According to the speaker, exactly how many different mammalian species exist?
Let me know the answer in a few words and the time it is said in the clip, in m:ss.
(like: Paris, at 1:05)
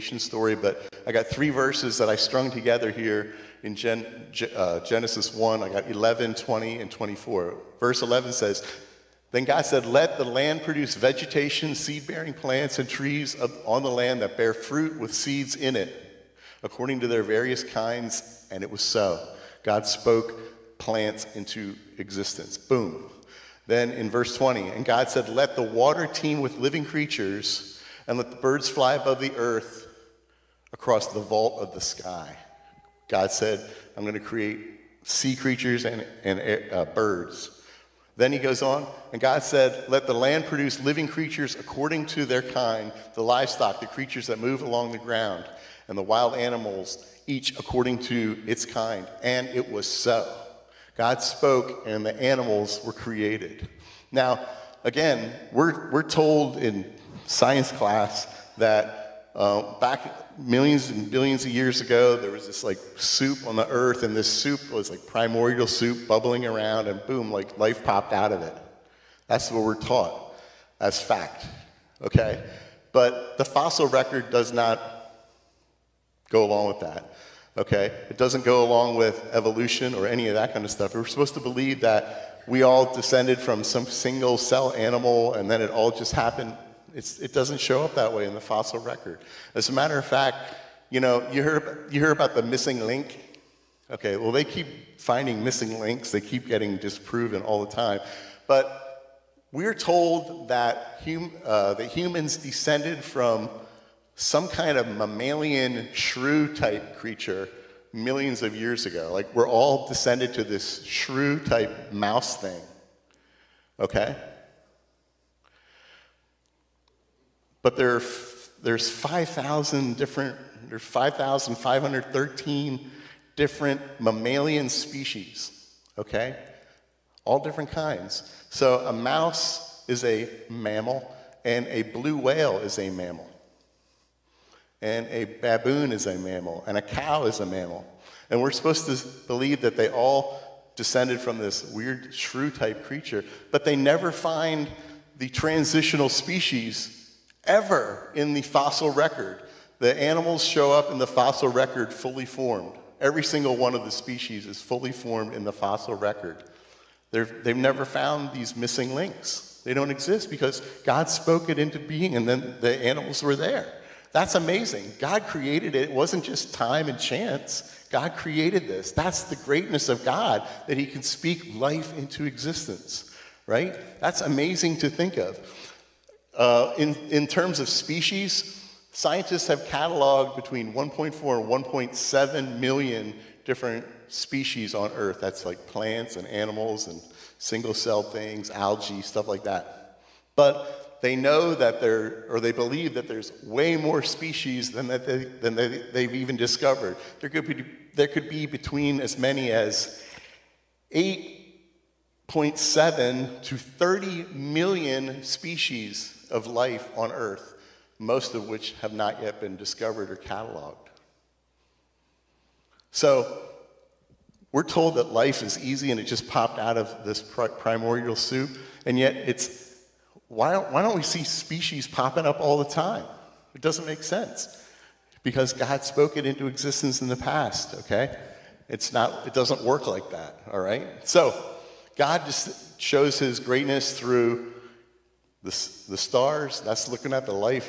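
5,513, at 2:00.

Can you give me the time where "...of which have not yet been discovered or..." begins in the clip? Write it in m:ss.
3:28.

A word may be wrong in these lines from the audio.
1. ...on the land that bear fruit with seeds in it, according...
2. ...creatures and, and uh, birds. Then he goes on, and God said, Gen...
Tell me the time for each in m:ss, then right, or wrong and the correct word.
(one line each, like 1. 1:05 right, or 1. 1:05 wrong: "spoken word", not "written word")
1. 0:13 right
2. 0:35 wrong: "Let", not "Gen".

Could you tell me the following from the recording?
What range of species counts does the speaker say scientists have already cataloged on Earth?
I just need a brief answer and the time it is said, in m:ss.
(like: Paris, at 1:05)
1.4 to 1.7 million, at 3:00.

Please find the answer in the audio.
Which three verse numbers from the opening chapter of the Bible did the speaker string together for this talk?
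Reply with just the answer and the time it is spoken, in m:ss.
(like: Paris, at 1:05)
11, 20, and 24, at 0:05.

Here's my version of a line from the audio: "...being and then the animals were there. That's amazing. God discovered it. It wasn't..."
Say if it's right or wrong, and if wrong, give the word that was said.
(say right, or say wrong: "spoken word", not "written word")
wrong: "created", not "discovered".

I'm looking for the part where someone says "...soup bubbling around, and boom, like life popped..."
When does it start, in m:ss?
1:05.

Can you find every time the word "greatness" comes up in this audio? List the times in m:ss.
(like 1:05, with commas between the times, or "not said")
2:49, 3:53.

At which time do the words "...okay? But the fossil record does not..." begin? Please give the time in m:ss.
1:12.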